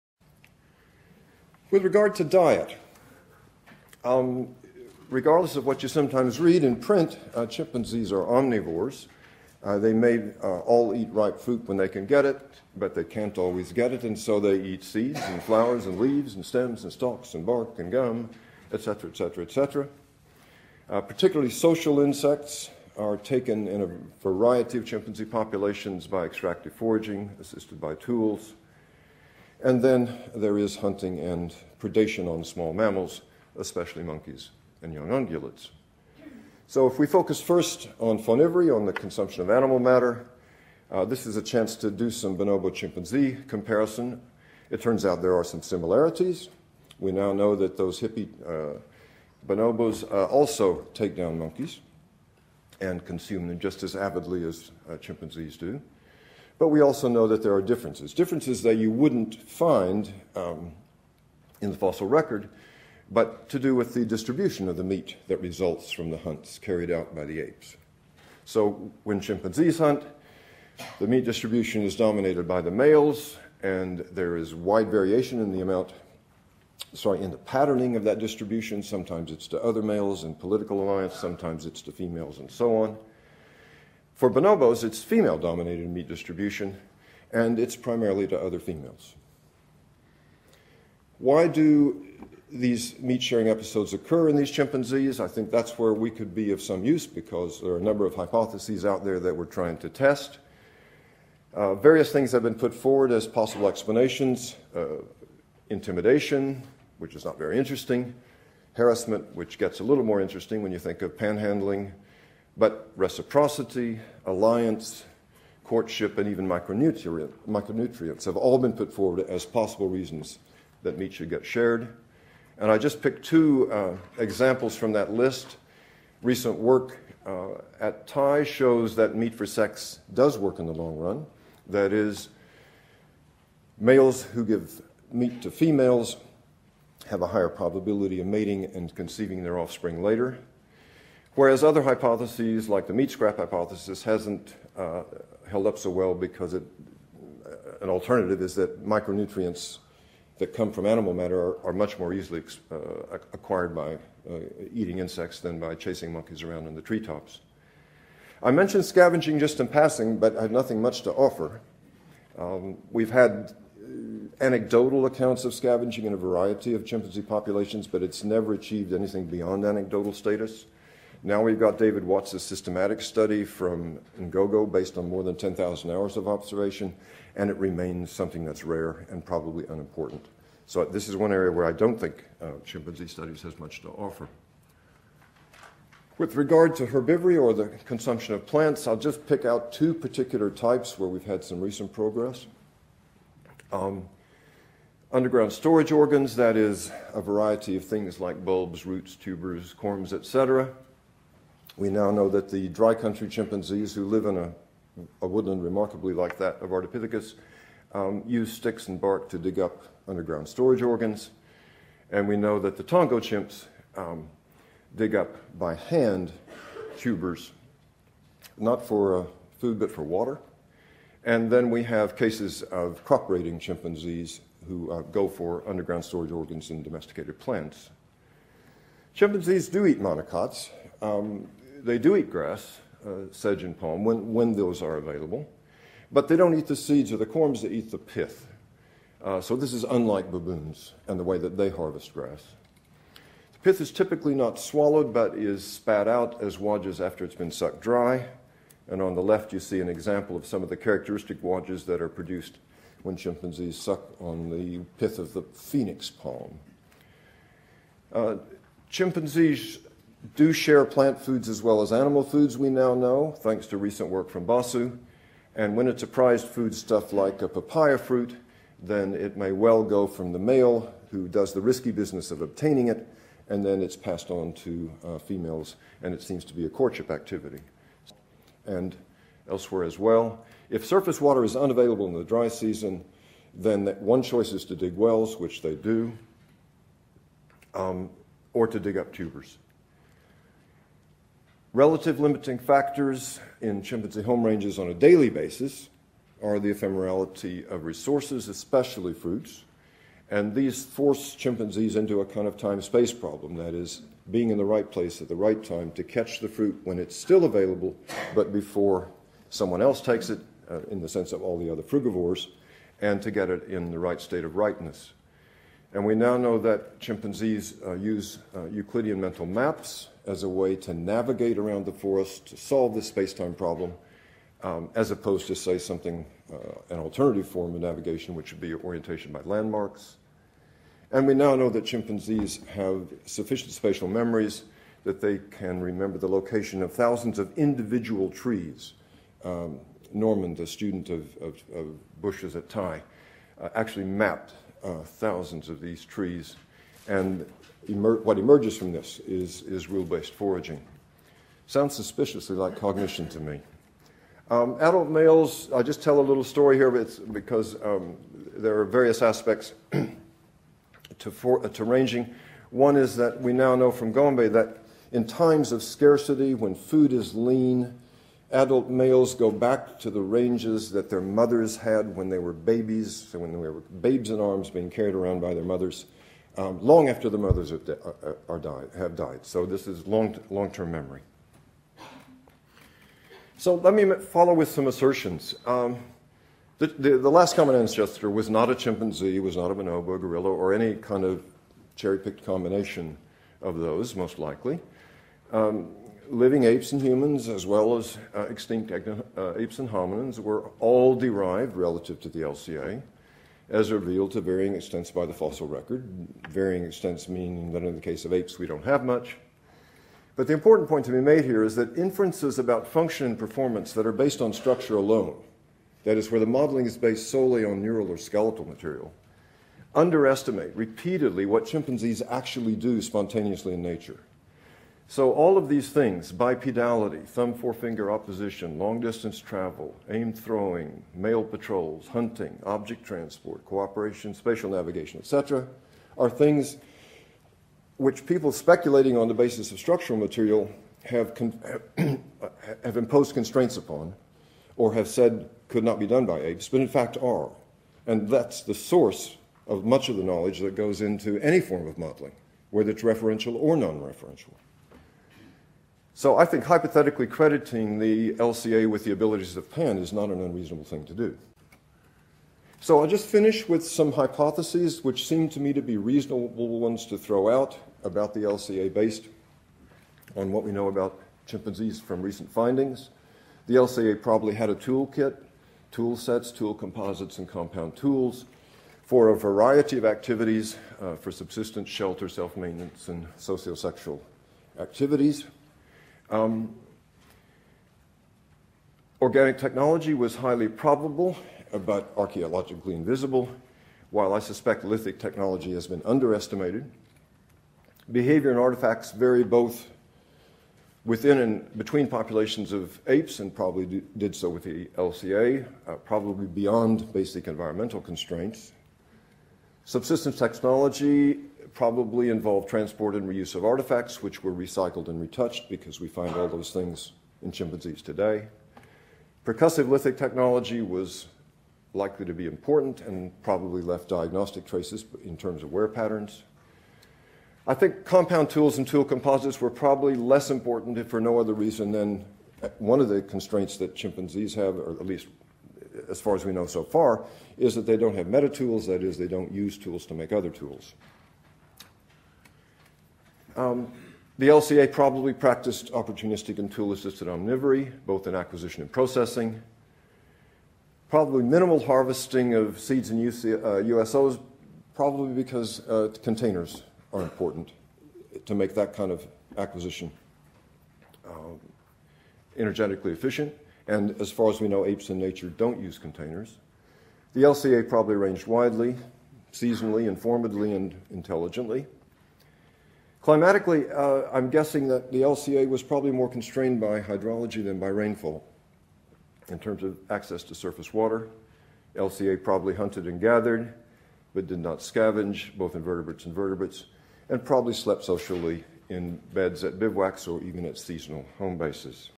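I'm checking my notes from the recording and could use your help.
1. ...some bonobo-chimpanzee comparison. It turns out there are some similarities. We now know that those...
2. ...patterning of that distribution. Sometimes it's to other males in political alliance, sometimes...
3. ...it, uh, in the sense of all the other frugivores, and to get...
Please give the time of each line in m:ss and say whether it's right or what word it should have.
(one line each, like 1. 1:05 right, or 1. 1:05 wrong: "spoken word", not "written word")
1. 0:42 right
2. 1:17 right
3. 5:10 right.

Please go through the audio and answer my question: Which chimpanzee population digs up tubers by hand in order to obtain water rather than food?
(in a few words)
Tongo.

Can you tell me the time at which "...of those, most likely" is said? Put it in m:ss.
6:33.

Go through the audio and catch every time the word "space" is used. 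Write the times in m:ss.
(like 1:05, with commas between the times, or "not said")
5:02, 5:23.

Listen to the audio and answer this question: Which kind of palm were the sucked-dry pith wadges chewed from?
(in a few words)
Phoenix palm.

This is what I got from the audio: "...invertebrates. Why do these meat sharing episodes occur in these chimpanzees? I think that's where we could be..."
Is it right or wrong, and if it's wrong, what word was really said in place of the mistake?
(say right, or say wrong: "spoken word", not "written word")
wrong: "females", not "invertebrates".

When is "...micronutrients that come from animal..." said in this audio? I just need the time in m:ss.
2:28.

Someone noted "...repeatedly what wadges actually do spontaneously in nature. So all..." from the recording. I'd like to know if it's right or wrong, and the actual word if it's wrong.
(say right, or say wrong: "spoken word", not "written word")
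wrong: "chimpanzees", not "wadges".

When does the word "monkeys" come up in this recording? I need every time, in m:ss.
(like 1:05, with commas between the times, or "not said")
0:34, 0:51, 2:36.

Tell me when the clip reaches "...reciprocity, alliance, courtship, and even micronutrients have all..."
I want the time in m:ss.
1:52.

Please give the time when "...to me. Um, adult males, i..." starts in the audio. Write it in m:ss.
5:53.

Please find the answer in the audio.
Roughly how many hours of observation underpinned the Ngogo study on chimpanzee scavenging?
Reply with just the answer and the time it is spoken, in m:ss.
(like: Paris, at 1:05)
10,000 hours, at 2:55.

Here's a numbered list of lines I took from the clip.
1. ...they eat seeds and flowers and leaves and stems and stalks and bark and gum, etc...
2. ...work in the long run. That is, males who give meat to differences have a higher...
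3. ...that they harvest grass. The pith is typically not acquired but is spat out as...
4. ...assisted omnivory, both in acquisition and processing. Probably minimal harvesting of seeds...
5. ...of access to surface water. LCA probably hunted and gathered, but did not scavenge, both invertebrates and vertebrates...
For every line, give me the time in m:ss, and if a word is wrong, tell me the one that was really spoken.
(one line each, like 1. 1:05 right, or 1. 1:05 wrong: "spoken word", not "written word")
1. 0:14 right
2. 2:10 wrong: "females", not "differences"
3. 4:01 wrong: "swallowed", not "acquired"
4. 9:06 right
5. 9:39 right.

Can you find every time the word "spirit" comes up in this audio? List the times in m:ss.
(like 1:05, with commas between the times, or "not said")
not said.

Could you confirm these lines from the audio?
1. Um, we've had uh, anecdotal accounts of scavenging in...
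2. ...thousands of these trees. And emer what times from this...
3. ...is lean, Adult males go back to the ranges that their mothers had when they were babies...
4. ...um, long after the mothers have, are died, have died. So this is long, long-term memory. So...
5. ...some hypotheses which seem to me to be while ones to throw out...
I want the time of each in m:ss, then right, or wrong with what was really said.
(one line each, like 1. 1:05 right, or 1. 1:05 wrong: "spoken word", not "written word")
1. 2:42 right
2. 5:45 wrong: "emerges", not "times"
3. 6:07 right
4. 6:16 right
5. 7:43 wrong: "reasonable", not "while".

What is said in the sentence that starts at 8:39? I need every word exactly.
Percussive lithic technology was likely to be important and probably left diagnostic traces in terms of wear patterns.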